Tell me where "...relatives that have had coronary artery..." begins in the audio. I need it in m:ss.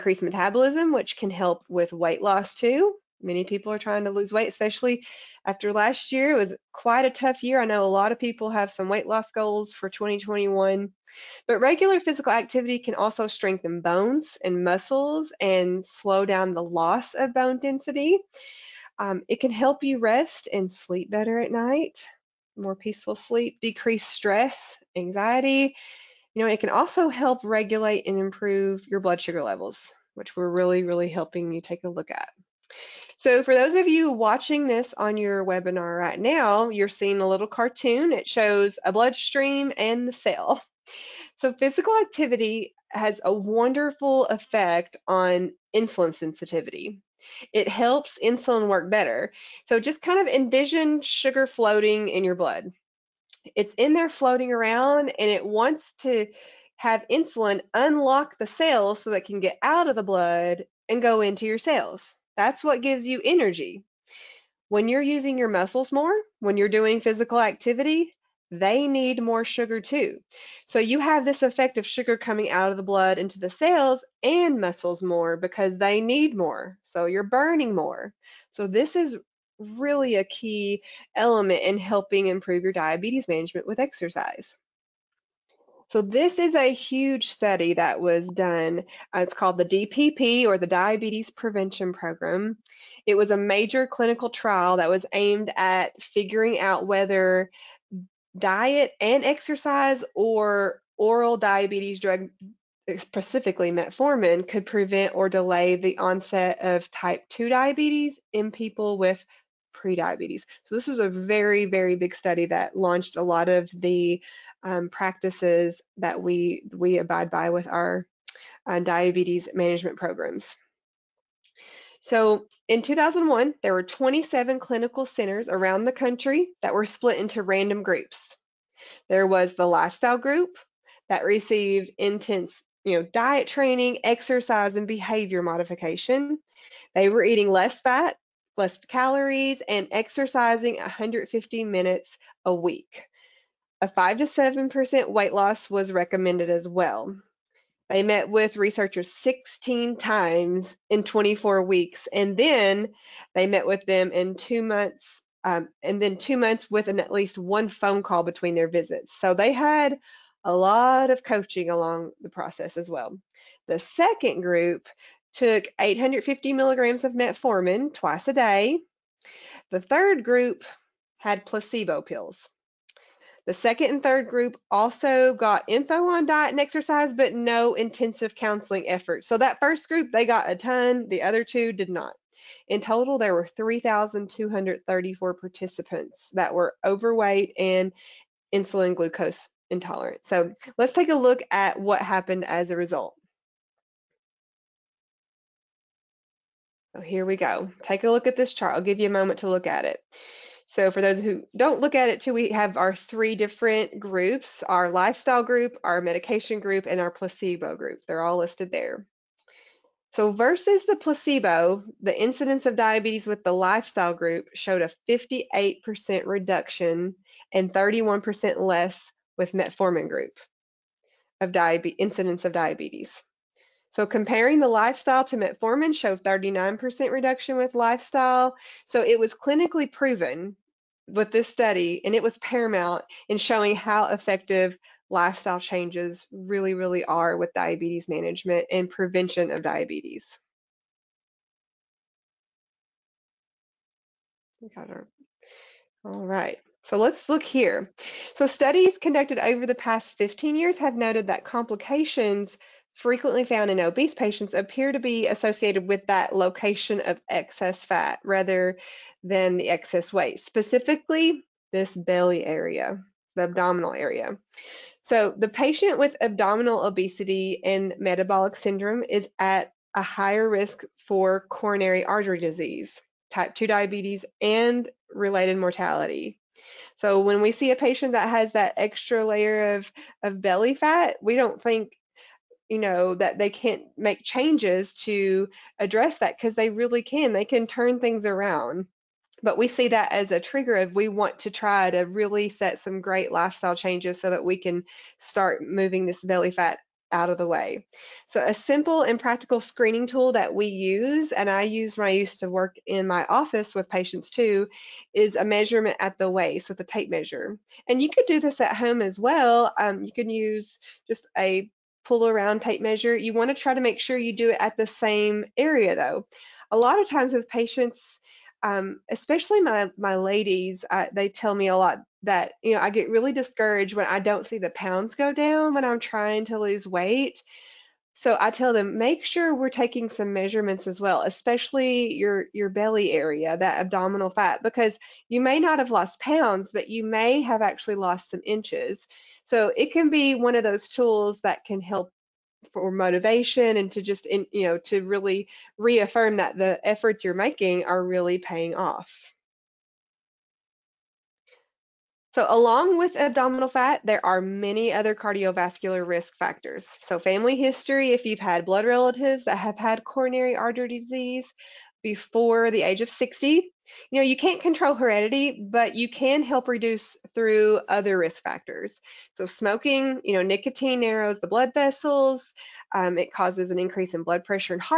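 5:58.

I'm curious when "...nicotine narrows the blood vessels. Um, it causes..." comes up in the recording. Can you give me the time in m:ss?
6:10.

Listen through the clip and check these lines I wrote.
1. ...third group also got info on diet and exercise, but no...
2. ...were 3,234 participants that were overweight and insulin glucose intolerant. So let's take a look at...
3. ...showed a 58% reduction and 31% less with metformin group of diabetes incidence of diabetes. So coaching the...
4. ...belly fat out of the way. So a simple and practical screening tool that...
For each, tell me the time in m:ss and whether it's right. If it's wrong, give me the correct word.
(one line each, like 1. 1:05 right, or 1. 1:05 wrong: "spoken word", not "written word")
1. 2:54 right
2. 3:03 right
3. 3:34 wrong: "comparing", not "coaching"
4. 4:56 right.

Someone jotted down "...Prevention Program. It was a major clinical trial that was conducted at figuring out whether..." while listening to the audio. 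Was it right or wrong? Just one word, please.
wrong.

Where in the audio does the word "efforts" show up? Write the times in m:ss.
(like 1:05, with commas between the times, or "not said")
2:58, 5:46.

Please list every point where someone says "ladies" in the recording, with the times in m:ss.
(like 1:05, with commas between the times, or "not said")
5:20.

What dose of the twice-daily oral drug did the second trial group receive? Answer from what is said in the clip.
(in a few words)
850 milligrams.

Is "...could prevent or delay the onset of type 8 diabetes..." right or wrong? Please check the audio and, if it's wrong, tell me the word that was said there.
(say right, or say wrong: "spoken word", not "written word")
wrong: "2", not "8".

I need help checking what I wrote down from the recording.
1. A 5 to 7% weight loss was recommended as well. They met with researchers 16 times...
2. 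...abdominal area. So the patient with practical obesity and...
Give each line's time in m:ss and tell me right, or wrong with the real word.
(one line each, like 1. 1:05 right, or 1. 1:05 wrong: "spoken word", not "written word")
1. 2:23 right
2. 4:23 wrong: "abdominal", not "practical".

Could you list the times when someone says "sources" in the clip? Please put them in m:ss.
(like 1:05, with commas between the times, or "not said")
not said.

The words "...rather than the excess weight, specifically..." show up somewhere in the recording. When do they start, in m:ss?
4:18.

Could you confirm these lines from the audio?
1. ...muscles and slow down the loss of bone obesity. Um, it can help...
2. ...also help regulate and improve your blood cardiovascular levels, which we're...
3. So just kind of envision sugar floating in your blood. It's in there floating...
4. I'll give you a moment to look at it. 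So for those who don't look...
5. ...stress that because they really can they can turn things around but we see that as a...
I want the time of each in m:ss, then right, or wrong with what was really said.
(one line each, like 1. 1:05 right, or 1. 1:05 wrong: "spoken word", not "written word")
1. 0:14 wrong: "density", not "obesity"
2. 0:26 wrong: "sugar", not "cardiovascular"
3. 0:49 right
4. 3:18 right
5. 4:45 wrong: "address", not "stress".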